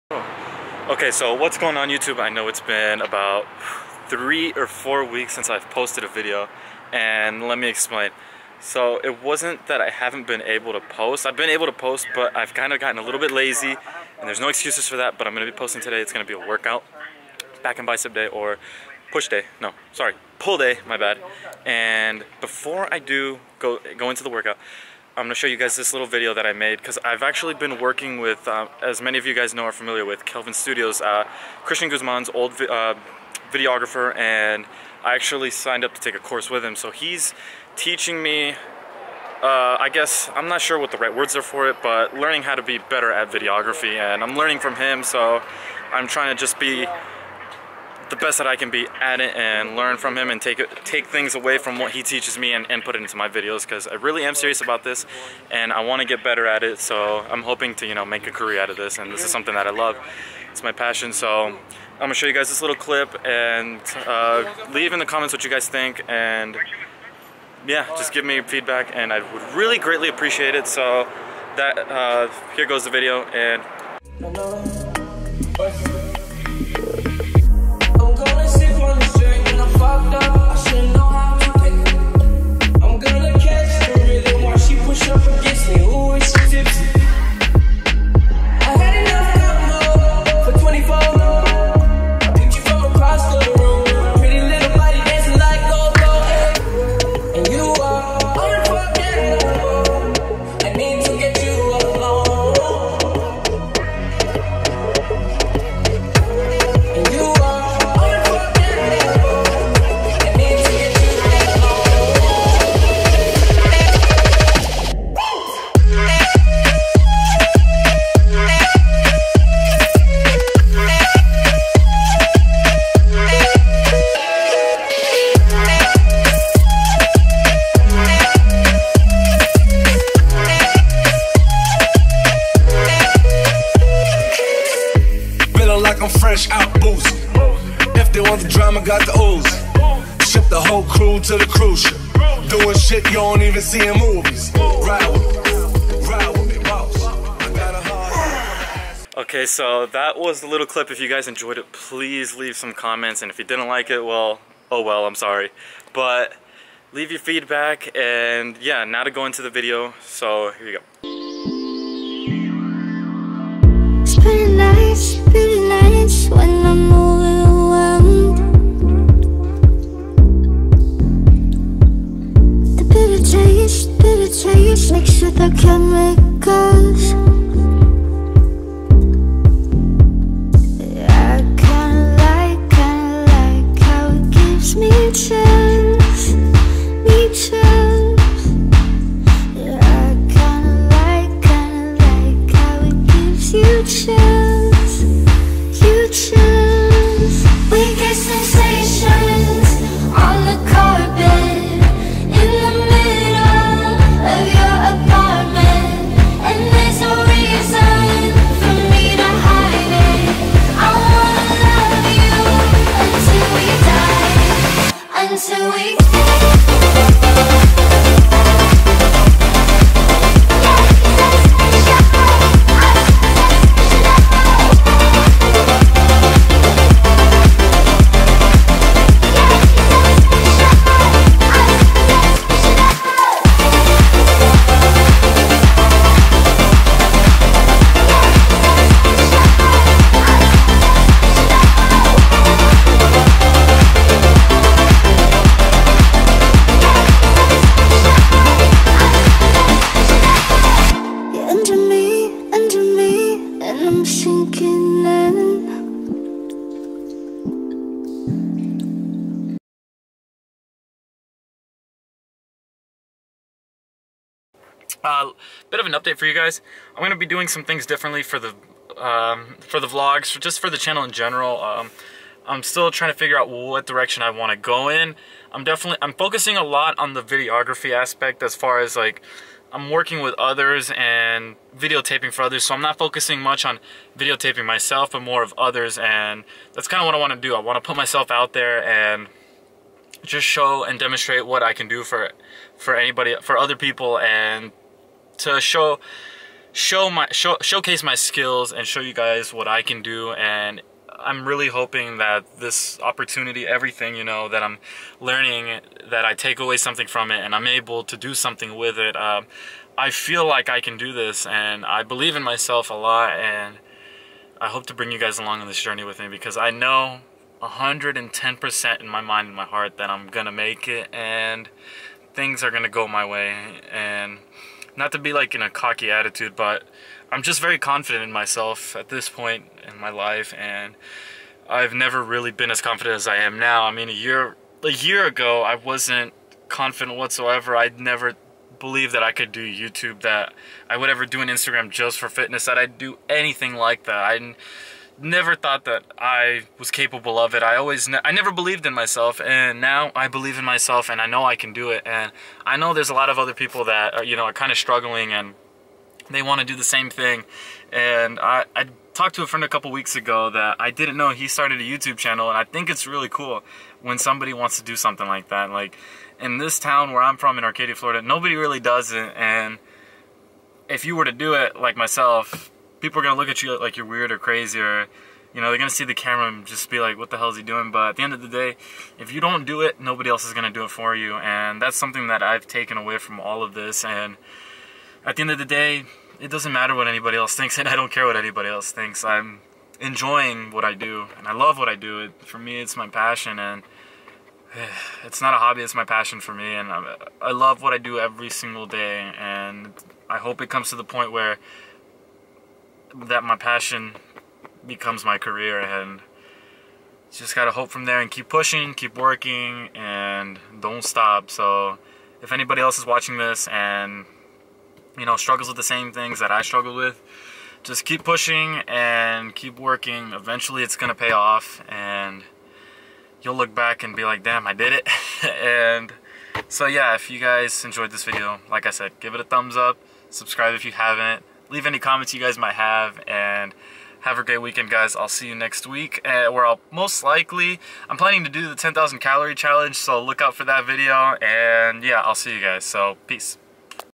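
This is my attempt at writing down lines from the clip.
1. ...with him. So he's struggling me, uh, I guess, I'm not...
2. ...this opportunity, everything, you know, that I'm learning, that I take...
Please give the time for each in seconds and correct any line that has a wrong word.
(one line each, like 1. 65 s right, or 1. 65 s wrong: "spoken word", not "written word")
1. 36 s wrong: "teaching", not "struggling"
2. 302 s right.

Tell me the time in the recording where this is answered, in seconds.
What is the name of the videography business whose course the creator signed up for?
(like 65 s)
30 s.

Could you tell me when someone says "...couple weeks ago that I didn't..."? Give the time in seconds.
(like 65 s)
359 s.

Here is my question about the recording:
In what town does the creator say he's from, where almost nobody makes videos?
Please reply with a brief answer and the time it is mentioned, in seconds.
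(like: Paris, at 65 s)
Arcadia, Florida, at 367 s.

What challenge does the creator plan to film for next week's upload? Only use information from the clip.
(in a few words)
10,000 calorie challenge.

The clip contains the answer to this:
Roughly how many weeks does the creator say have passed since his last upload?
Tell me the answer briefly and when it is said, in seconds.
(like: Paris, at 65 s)
3 or 4, at 4 s.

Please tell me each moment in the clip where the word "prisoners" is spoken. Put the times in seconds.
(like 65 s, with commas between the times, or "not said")
not said.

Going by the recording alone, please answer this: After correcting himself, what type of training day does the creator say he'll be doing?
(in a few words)
Pull day.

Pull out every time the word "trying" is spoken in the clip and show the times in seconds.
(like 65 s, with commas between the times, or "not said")
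46 s, 272 s.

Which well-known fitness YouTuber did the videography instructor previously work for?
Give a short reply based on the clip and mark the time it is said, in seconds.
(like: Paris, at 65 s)
Christian Guzman, at 31 s.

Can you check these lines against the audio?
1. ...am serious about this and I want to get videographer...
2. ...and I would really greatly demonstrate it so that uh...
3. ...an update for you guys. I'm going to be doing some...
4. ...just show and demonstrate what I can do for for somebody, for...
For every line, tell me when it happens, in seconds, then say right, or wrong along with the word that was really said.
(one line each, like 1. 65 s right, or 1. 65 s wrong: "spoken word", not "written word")
1. 54 s wrong: "better", not "videographer"
2. 68 s wrong: "appreciate", not "demonstrate"
3. 265 s right
4. 290 s wrong: "anybody", not "somebody".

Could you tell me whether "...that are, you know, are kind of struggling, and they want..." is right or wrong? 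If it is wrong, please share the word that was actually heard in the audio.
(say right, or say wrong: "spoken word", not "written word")
right.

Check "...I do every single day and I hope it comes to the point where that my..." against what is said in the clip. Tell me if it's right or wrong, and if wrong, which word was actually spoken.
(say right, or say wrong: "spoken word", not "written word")
right.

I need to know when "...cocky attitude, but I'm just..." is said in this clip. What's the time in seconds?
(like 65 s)
325 s.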